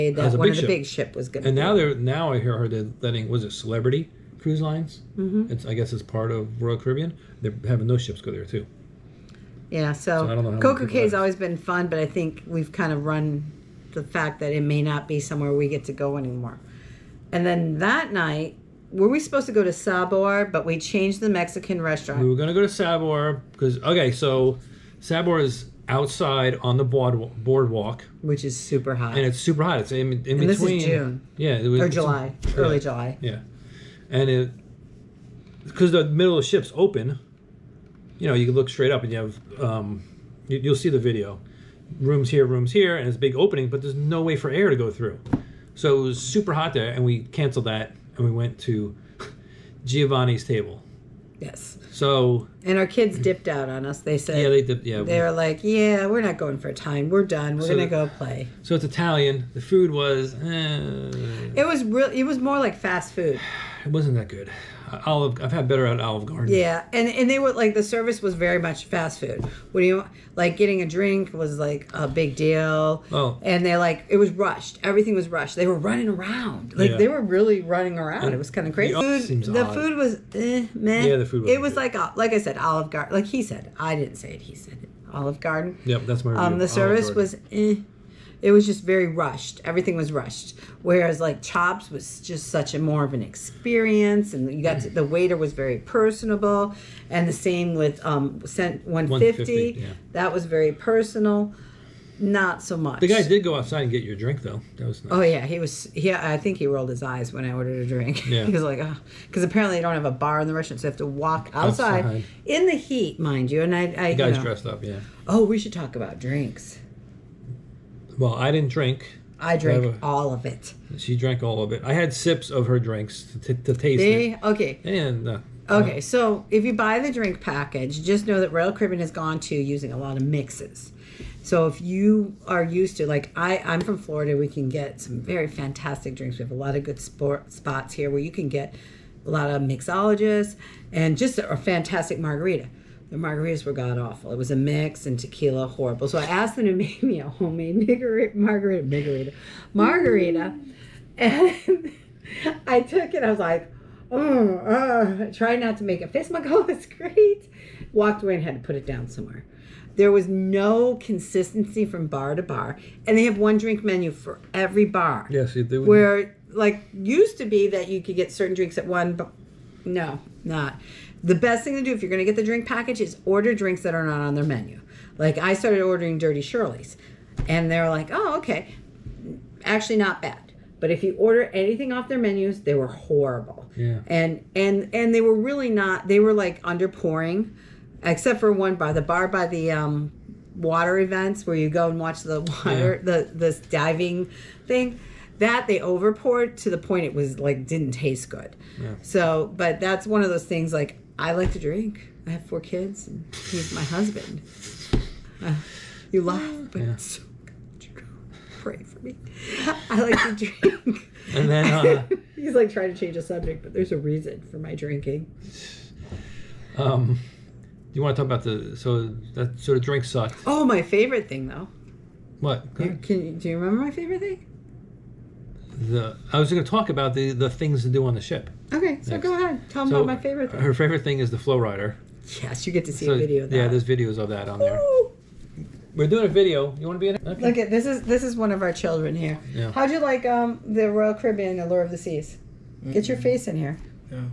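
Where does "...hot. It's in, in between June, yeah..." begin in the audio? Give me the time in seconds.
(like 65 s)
29 s.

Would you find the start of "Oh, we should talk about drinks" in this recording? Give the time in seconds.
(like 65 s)
115 s.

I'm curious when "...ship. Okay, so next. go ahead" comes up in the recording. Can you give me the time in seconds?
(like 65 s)
228 s.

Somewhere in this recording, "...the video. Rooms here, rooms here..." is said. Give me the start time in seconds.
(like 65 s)
40 s.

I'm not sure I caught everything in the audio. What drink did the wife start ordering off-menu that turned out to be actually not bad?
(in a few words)
Dirty Shirley.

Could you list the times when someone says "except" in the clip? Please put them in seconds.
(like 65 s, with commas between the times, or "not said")
188 s.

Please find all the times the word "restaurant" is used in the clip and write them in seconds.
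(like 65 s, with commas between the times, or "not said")
21 s, 110 s.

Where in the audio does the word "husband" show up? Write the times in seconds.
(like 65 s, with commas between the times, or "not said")
203 s.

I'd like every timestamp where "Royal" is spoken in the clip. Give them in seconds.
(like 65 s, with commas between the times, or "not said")
6 s, 128 s, 240 s.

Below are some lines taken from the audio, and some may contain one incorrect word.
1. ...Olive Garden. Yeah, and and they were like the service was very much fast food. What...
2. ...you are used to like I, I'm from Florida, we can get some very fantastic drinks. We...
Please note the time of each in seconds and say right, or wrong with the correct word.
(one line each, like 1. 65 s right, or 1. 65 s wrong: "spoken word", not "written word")
1. 66 s right
2. 131 s right.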